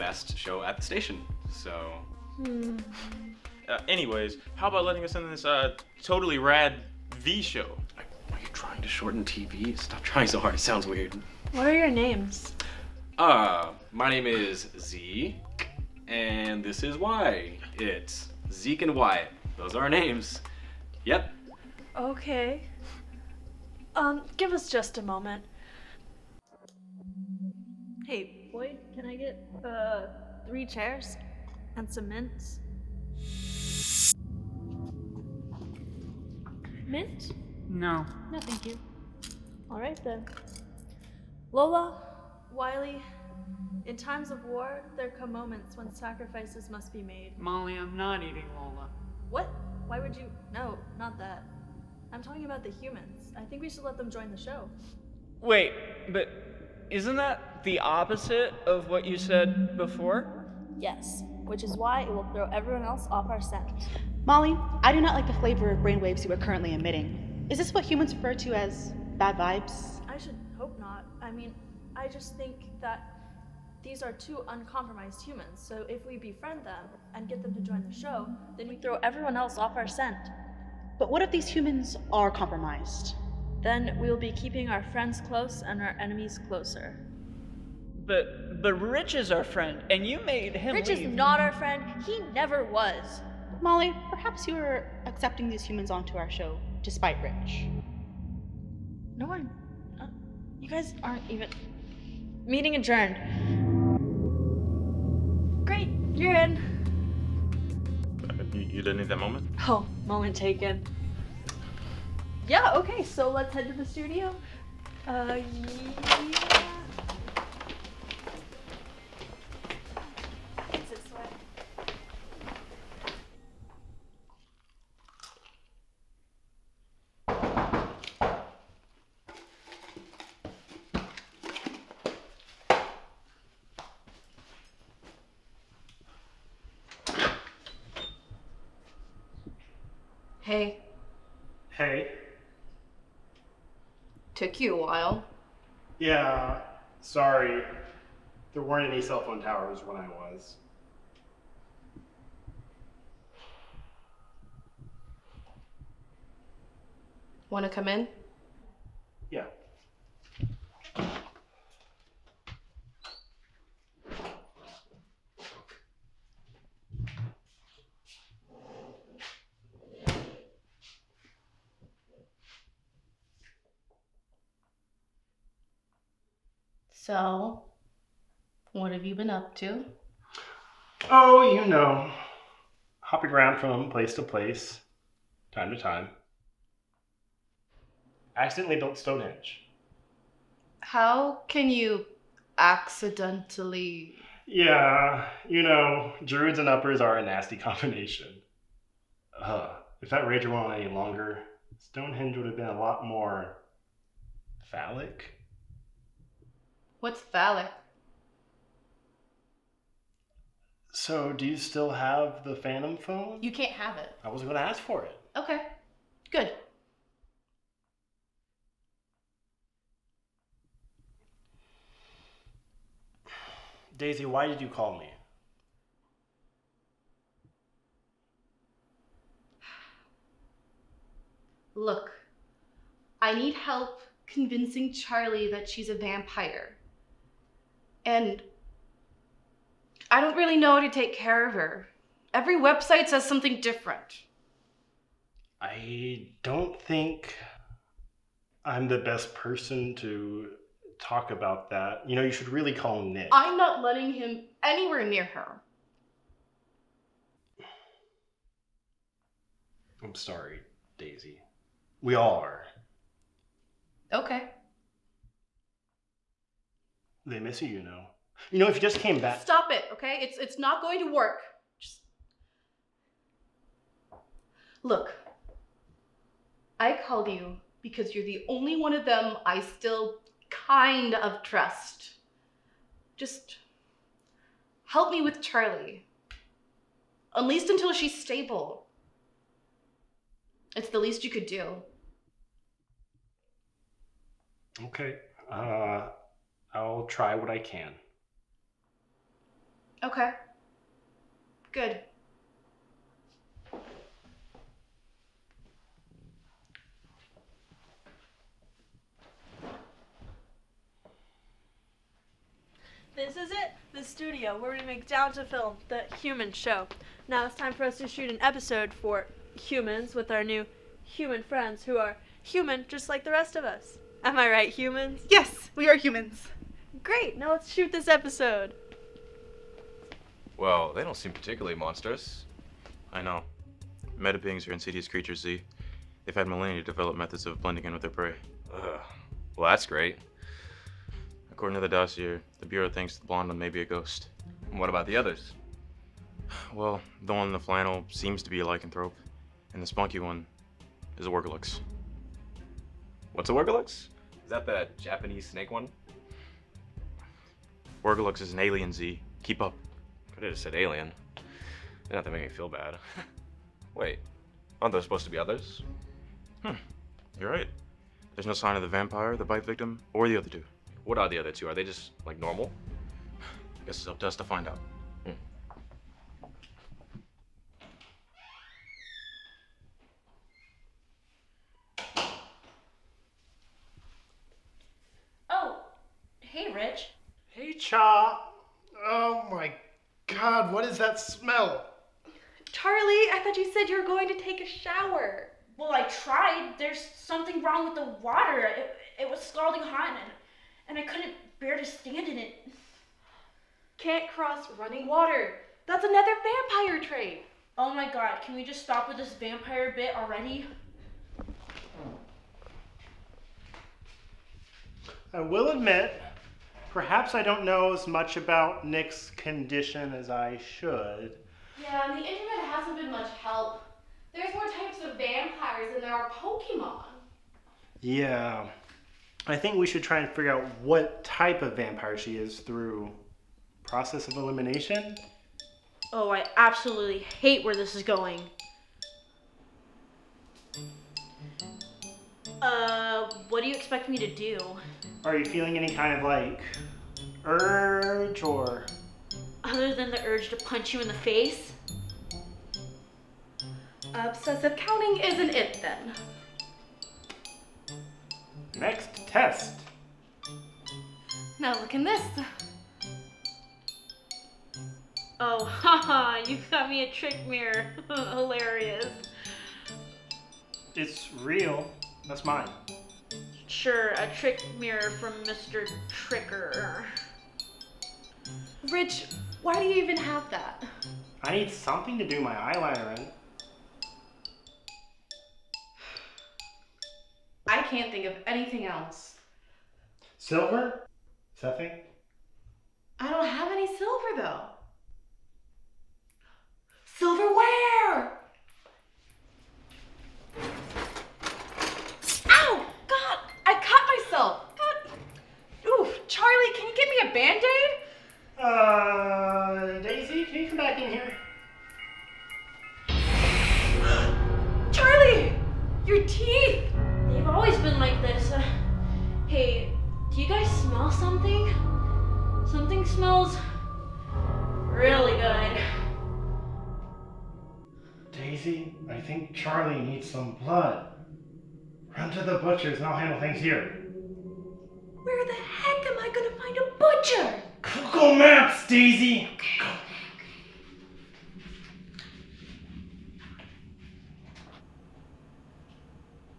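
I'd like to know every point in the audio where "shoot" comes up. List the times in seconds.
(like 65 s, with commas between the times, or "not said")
318 s, 327 s.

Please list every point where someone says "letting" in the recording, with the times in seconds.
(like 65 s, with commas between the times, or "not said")
4 s, 253 s.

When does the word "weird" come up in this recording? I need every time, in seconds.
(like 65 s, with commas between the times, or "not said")
10 s.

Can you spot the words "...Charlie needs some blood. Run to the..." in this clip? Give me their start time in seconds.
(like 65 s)
529 s.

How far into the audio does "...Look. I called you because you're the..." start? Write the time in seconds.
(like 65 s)
274 s.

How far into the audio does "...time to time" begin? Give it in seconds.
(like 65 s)
185 s.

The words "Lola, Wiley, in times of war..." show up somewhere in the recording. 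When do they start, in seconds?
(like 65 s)
41 s.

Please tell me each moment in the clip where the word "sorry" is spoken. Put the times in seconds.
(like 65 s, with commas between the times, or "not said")
147 s, 260 s.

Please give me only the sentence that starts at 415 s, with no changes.
I will admit, Perhaps I don't know as much about Nick's condition as I should.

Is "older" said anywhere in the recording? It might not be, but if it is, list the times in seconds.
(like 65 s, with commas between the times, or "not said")
not said.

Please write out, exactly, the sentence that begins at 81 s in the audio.
But what if these humans are compromised?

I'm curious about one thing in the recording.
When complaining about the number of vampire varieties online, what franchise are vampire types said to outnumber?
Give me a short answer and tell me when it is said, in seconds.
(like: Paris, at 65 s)
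Pokemon, at 426 s.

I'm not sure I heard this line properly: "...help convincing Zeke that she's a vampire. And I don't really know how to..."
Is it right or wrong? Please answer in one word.
wrong.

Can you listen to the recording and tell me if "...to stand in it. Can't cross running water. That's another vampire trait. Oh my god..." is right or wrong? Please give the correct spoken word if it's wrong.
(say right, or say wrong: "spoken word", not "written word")
right.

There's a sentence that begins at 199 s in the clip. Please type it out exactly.
Uh, if that rager went on any longer, Stonehenge would have been a lot more phallic.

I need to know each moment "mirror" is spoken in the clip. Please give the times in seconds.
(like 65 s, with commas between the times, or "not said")
467 s, 474 s.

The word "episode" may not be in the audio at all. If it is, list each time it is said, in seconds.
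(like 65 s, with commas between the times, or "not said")
318 s, 328 s.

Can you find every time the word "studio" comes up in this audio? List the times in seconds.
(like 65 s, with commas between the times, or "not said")
113 s, 314 s.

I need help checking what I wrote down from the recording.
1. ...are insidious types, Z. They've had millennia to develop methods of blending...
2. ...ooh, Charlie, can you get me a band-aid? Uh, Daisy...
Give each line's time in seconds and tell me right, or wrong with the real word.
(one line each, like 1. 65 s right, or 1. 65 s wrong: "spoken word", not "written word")
1. 334 s wrong: "creatures", not "types"
2. 505 s right.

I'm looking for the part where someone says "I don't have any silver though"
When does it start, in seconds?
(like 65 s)
493 s.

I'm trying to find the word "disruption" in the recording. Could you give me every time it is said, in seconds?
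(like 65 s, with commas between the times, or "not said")
not said.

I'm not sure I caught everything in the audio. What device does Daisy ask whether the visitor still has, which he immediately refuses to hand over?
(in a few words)
Phantom phone.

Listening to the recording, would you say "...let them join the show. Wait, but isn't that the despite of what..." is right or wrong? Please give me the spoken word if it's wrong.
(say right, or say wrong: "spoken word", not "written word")
wrong: "opposite", not "despite".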